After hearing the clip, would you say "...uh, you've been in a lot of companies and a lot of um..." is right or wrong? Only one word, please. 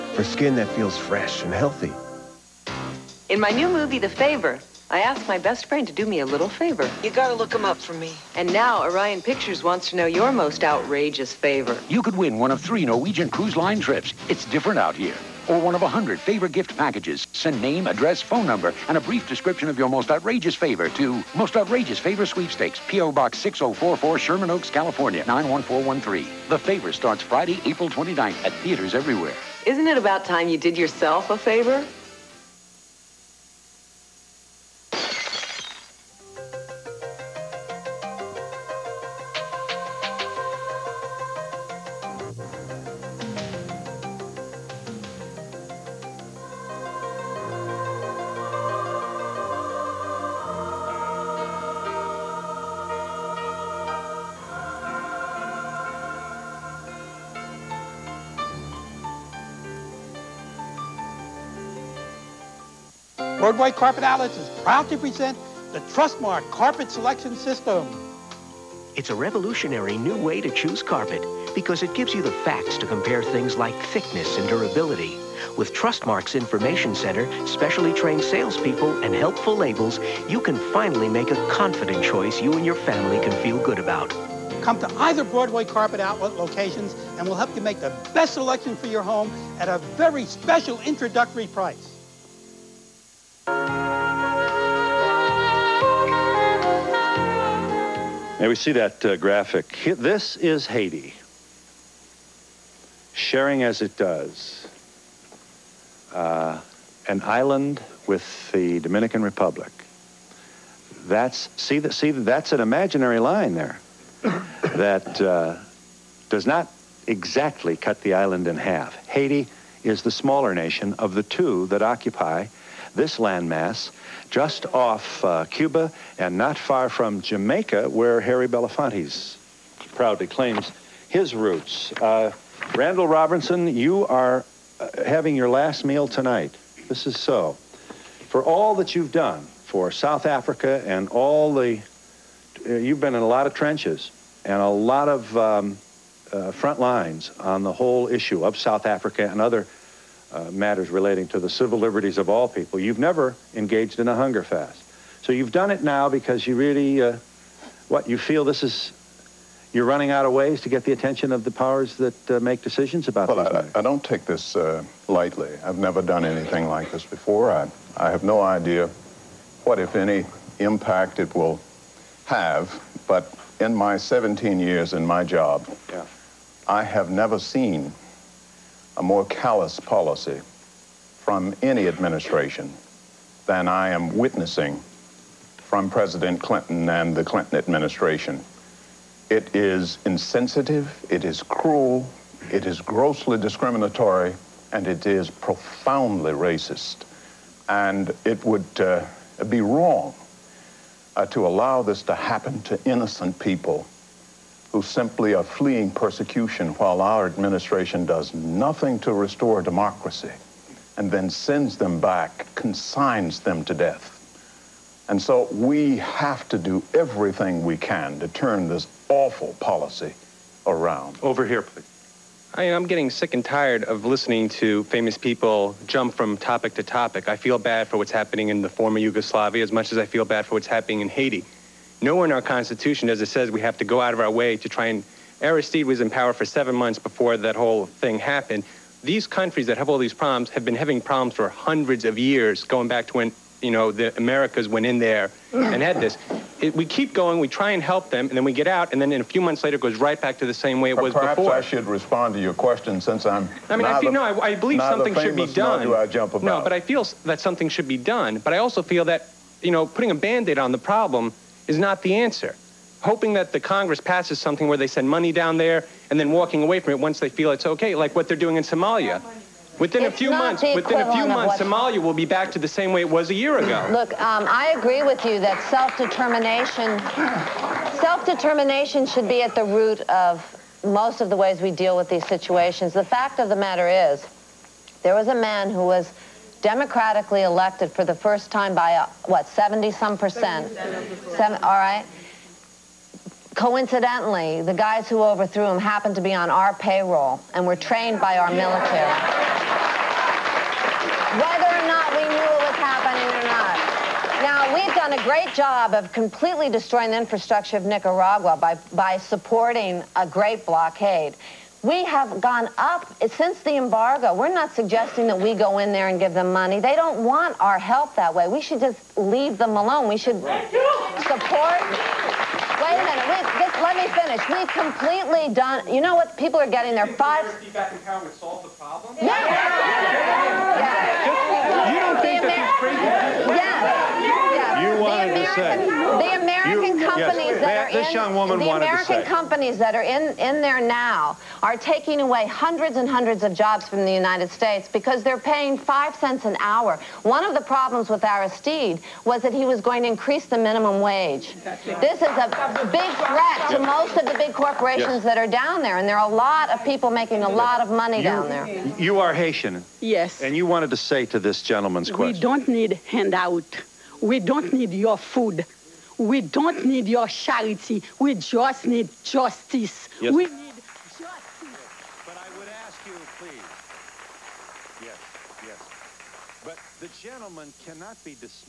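wrong.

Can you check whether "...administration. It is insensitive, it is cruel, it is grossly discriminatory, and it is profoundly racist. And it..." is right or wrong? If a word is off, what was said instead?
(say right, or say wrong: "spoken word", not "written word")
right.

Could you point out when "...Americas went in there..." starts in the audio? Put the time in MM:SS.
04:04.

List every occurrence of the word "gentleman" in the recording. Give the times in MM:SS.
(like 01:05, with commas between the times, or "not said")
06:01, 06:17.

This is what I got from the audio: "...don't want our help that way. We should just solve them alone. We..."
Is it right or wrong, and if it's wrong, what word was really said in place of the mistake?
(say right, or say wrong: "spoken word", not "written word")
wrong: "leave", not "solve".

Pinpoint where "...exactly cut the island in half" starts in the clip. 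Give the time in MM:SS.
01:57.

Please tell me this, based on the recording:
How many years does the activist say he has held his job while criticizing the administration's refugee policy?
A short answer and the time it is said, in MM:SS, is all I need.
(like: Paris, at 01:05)
17 years, at 02:53.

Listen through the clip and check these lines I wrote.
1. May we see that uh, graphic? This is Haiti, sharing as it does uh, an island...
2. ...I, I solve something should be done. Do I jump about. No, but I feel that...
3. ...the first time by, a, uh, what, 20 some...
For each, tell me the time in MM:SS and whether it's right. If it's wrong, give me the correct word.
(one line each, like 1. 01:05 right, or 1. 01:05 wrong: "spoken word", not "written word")
1. 01:38 right
2. 04:14 wrong: "believe", not "solve"
3. 04:48 wrong: "70", not "20".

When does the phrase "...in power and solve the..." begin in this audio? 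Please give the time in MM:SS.
05:27.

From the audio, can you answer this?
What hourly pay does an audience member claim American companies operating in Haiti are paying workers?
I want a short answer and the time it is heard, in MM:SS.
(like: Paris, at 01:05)
5 cents an hour, at 05:45.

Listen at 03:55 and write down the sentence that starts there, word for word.
Aristide was in power for seven months before that whole thing happened.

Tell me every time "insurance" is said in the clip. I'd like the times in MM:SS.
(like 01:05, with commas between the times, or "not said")
not said.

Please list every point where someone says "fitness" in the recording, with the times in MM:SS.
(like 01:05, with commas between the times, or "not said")
not said.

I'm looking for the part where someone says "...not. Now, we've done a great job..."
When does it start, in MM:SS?
05:03.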